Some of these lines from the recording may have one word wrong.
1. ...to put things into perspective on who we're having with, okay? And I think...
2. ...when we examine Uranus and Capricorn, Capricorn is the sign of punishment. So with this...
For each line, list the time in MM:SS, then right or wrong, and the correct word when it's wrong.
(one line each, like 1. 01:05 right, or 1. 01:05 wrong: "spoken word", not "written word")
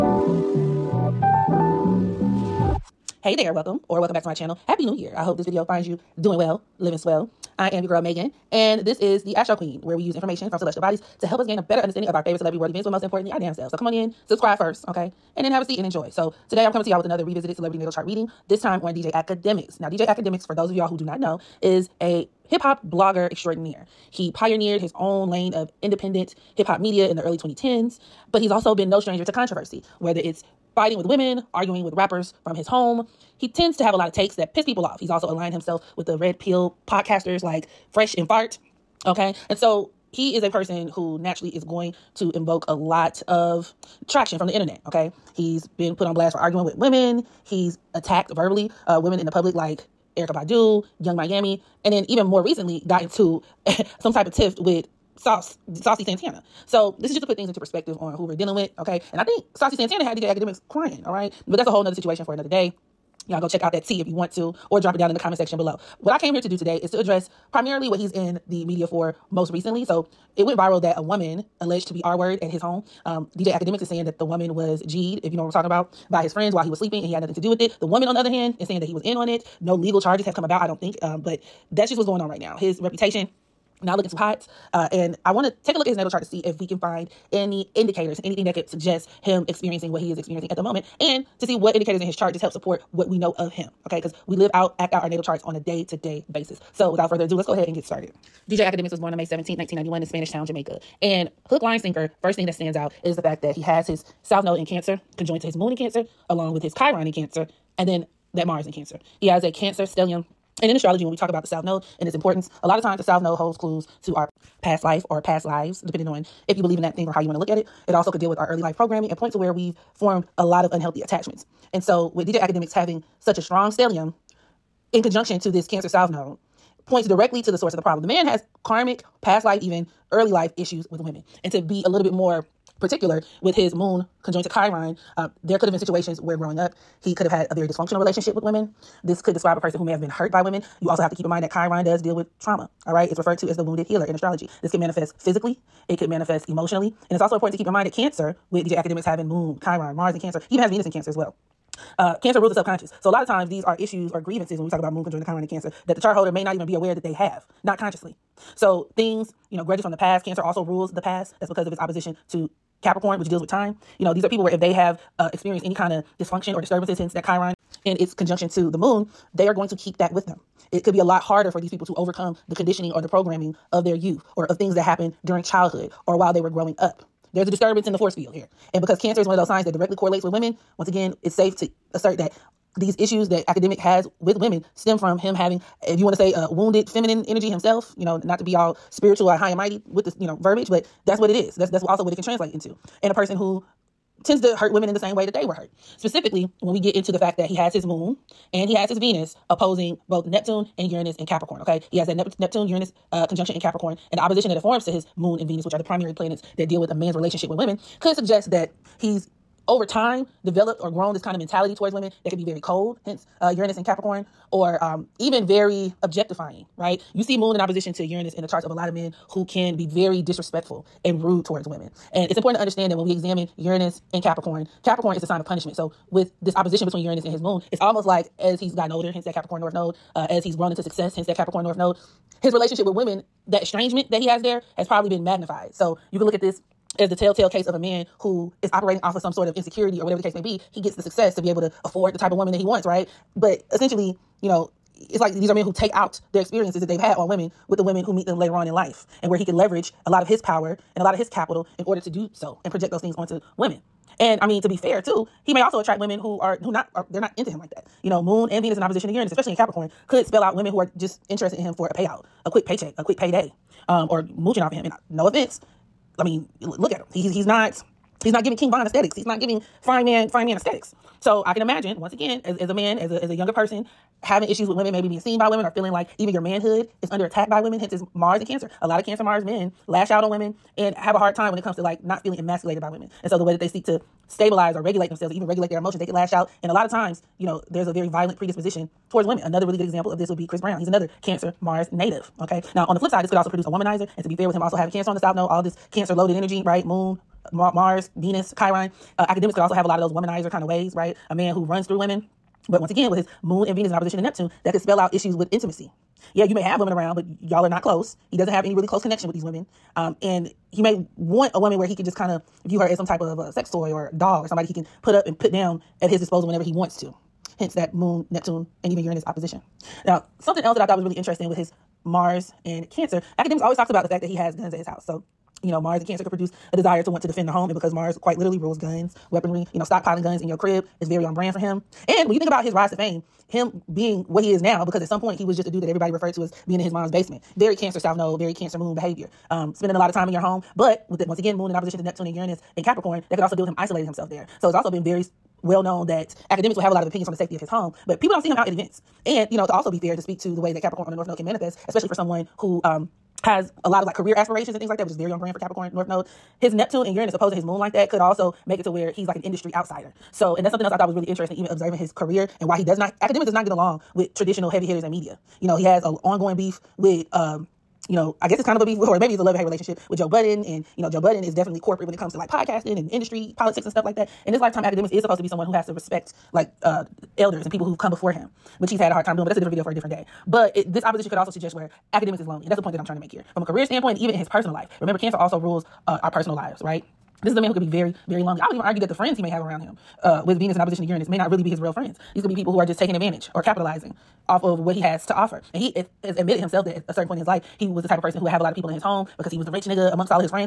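1. 00:57 wrong: "dealing", not "having"
2. 03:42 right.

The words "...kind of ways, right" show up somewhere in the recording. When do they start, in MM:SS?
05:00.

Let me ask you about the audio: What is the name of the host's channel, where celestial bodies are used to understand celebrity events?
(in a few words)
The Astro Queen.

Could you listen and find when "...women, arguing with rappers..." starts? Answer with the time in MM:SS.
00:31.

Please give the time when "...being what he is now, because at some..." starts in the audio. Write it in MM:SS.
05:33.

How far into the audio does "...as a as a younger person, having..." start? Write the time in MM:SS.
04:32.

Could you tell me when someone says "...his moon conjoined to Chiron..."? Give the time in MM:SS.
02:13.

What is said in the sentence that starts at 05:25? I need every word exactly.
So, you know, Mars and Cancer could produce a desire to want to defend the home.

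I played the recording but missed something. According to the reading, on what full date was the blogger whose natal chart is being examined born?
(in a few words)
May 17, 1991.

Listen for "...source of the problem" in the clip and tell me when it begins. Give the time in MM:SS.
02:07.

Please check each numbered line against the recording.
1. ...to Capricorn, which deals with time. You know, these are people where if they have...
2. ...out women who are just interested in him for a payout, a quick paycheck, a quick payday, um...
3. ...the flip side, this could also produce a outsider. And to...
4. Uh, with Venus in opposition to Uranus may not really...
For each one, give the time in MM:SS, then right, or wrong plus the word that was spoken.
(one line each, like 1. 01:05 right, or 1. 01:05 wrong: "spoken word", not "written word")
1. 02:42 right
2. 04:20 right
3. 04:52 wrong: "womanizer", not "outsider"
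4. 06:30 right.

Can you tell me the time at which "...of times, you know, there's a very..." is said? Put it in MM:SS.
04:46.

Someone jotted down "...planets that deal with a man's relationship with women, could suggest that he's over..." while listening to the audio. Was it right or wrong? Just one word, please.
right.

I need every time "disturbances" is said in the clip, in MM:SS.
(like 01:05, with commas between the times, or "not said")
02:46, 02:57.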